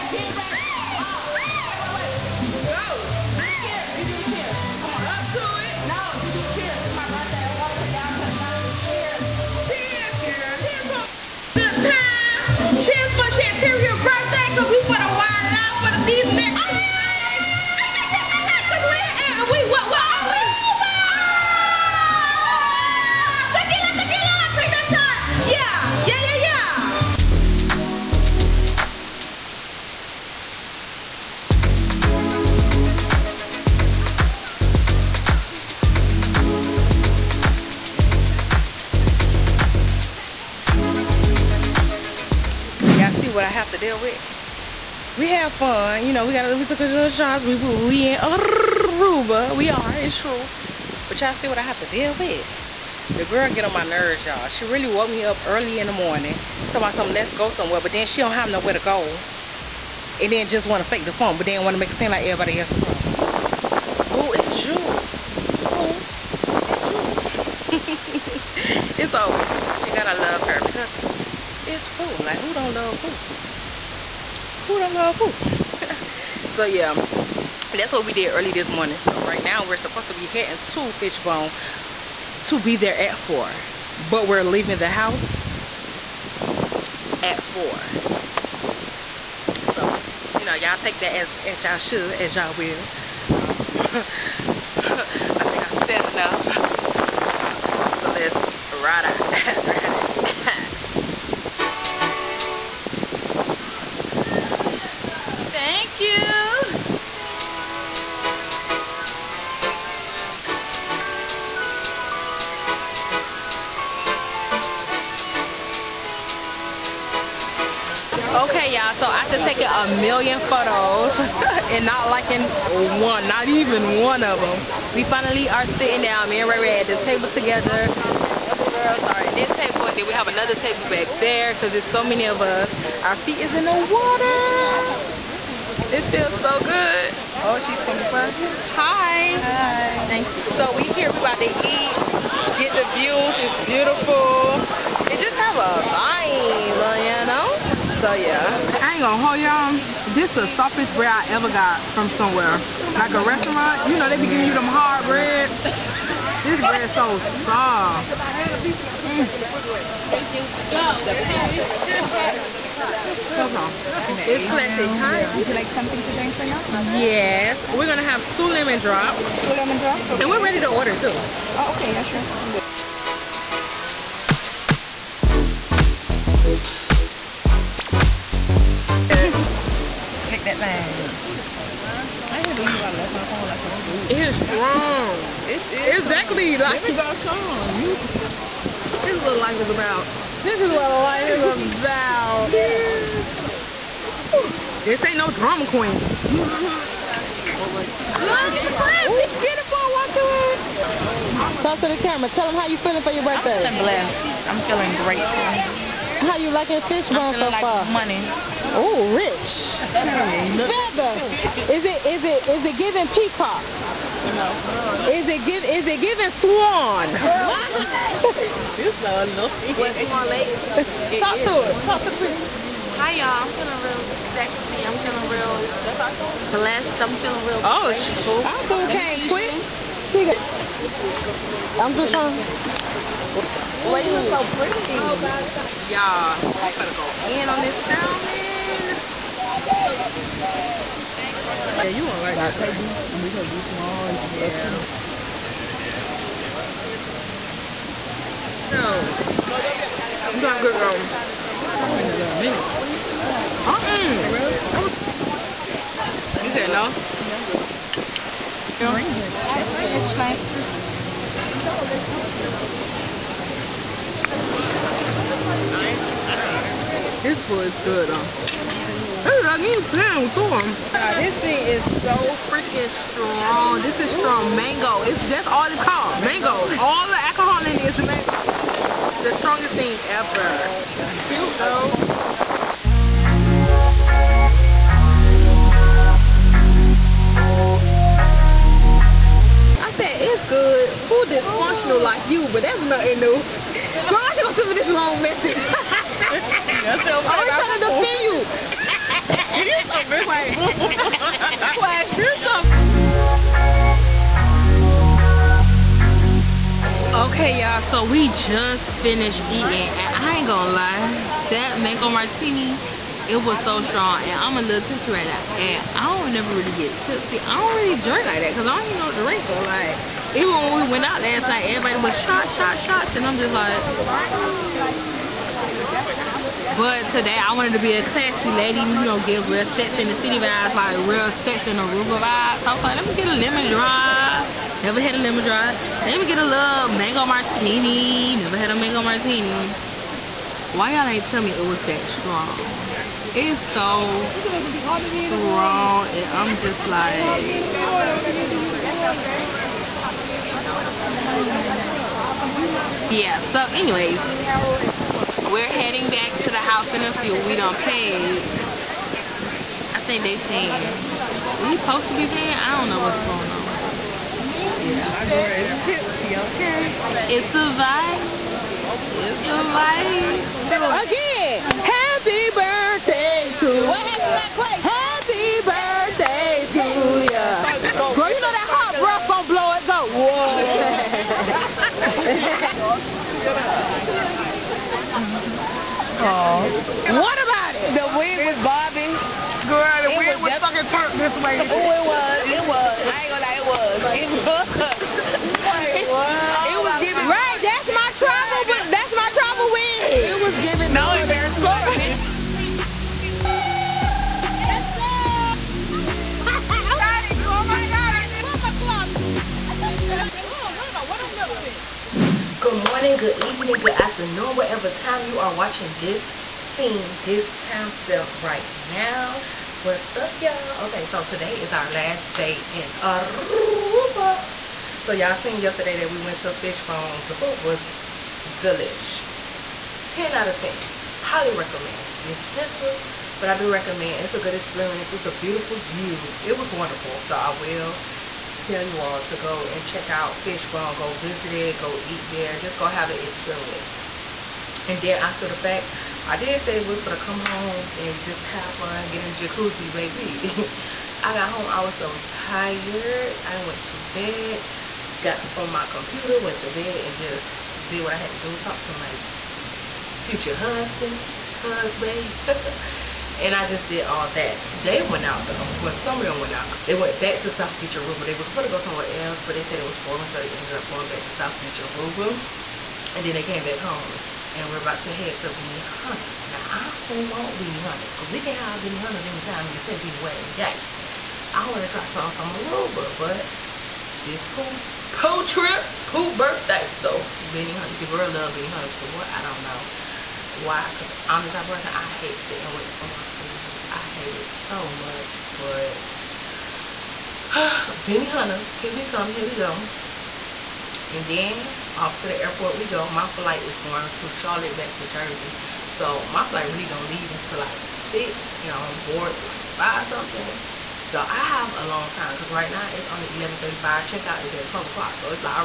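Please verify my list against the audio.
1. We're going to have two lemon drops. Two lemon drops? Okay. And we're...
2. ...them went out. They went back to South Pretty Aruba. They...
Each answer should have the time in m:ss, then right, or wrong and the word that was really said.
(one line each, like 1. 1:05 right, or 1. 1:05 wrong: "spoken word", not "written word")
1. 2:47 right
2. 7:46 wrong: "Beach", not "Pretty".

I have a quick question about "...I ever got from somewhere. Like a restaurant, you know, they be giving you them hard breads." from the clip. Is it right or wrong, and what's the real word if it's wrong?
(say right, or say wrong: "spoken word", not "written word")
right.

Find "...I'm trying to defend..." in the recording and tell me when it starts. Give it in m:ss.
4:56.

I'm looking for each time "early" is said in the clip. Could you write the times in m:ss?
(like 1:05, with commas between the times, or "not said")
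0:55, 1:18.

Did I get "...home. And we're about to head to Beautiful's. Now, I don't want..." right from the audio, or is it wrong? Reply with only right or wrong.
wrong.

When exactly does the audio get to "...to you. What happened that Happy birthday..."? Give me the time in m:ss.
6:13.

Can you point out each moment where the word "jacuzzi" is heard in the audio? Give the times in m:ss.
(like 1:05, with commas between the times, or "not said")
7:29.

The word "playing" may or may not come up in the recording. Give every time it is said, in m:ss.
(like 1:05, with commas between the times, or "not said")
4:29.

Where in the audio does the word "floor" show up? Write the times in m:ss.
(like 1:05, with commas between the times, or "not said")
not said.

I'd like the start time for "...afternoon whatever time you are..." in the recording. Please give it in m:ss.
6:53.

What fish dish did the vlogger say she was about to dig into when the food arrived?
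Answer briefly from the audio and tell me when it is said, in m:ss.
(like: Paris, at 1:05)
Salmon, at 3:57.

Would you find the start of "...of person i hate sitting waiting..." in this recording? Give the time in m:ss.
8:11.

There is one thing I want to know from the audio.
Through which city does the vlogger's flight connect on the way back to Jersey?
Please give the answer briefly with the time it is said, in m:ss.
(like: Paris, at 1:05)
Charlotte, at 8:24.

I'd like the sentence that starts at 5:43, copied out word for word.
It's so strong and I'm just like...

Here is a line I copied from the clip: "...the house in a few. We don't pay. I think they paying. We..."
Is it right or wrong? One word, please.
right.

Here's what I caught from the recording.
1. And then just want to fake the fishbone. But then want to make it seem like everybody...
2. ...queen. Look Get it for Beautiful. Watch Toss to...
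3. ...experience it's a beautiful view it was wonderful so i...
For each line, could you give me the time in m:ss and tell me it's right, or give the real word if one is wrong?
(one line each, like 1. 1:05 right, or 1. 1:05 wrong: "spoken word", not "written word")
1. 1:00 wrong: "phone", not "fishbone"
2. 3:15 right
3. 7:14 right.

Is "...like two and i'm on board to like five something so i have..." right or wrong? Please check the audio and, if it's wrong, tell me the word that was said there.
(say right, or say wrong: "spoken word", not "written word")
wrong: "six", not "two".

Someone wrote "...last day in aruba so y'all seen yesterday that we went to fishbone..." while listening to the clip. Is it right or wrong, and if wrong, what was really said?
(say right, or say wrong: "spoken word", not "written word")
right.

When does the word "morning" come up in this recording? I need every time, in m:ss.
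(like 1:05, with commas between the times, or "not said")
0:55, 1:18, 6:52.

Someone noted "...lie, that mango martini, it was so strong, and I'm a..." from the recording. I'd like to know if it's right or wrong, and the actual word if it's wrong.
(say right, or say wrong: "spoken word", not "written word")
right.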